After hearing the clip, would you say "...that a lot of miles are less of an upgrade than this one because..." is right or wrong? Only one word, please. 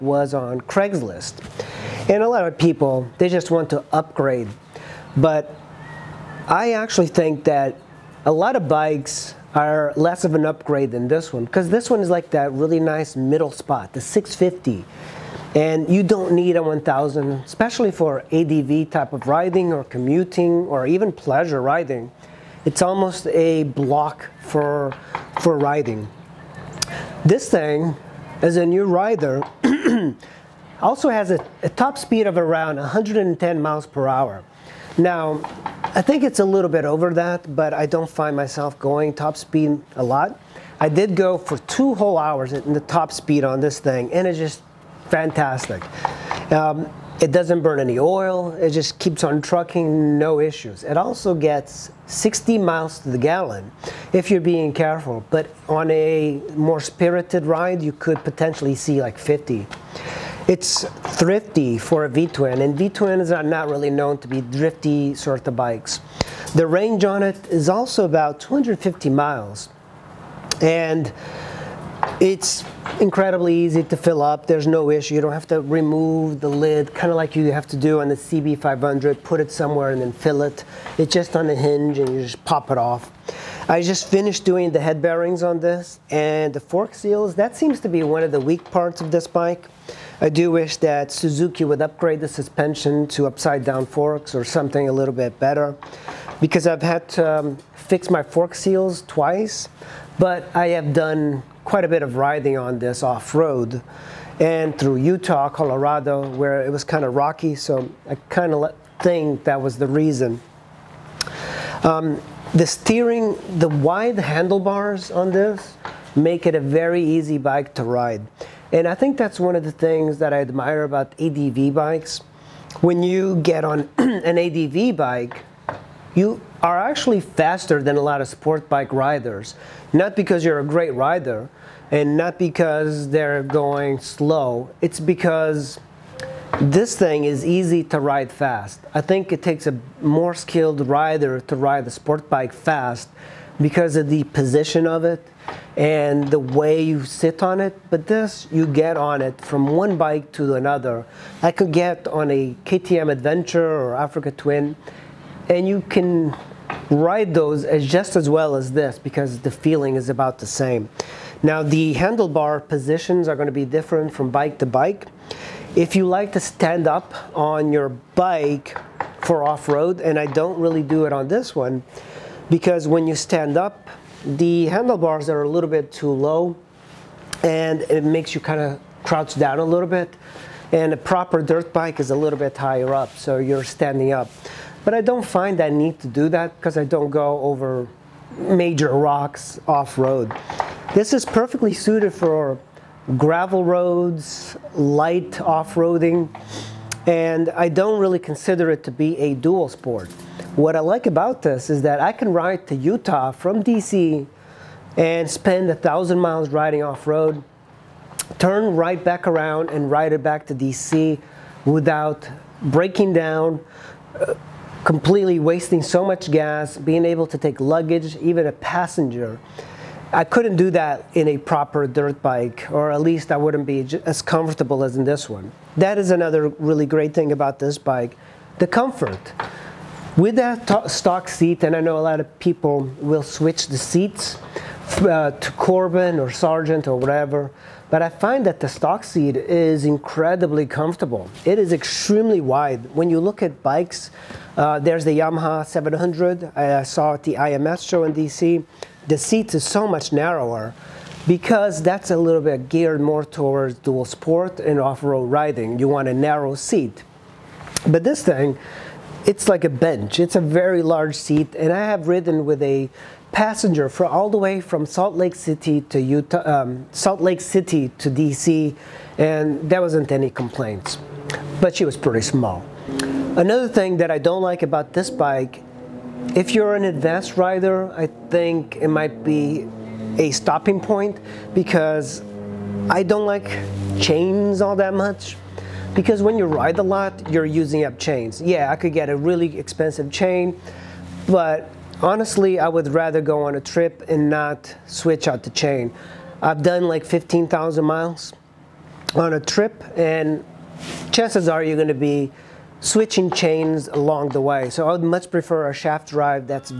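wrong.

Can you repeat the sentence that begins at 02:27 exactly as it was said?
But this, you get on it from one bike to another.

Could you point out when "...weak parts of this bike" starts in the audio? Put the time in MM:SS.
01:28.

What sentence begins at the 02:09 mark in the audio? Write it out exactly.
Not because you're a great rider and not because they're going slow, it's because this thing is easy to ride fast.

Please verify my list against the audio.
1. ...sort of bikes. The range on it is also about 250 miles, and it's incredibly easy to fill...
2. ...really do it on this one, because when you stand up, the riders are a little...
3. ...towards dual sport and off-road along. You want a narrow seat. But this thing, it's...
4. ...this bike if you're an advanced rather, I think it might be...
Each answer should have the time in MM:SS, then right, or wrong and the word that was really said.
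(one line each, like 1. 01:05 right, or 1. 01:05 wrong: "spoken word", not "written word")
1. 01:05 right
2. 02:50 wrong: "handlebars", not "riders"
3. 04:13 wrong: "riding", not "along"
4. 04:34 wrong: "rider", not "rather".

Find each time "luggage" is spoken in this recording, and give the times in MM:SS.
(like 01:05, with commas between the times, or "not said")
03:37.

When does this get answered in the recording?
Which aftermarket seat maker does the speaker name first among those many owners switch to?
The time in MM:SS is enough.
03:55.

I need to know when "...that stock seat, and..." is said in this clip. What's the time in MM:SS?
03:50.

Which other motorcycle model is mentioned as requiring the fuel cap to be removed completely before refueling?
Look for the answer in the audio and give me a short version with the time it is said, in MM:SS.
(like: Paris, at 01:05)
CB500, at 01:18.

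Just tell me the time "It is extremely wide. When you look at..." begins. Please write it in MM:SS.
04:01.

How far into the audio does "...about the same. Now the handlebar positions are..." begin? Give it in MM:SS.
02:40.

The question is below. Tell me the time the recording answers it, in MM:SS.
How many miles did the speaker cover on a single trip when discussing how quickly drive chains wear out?
04:57.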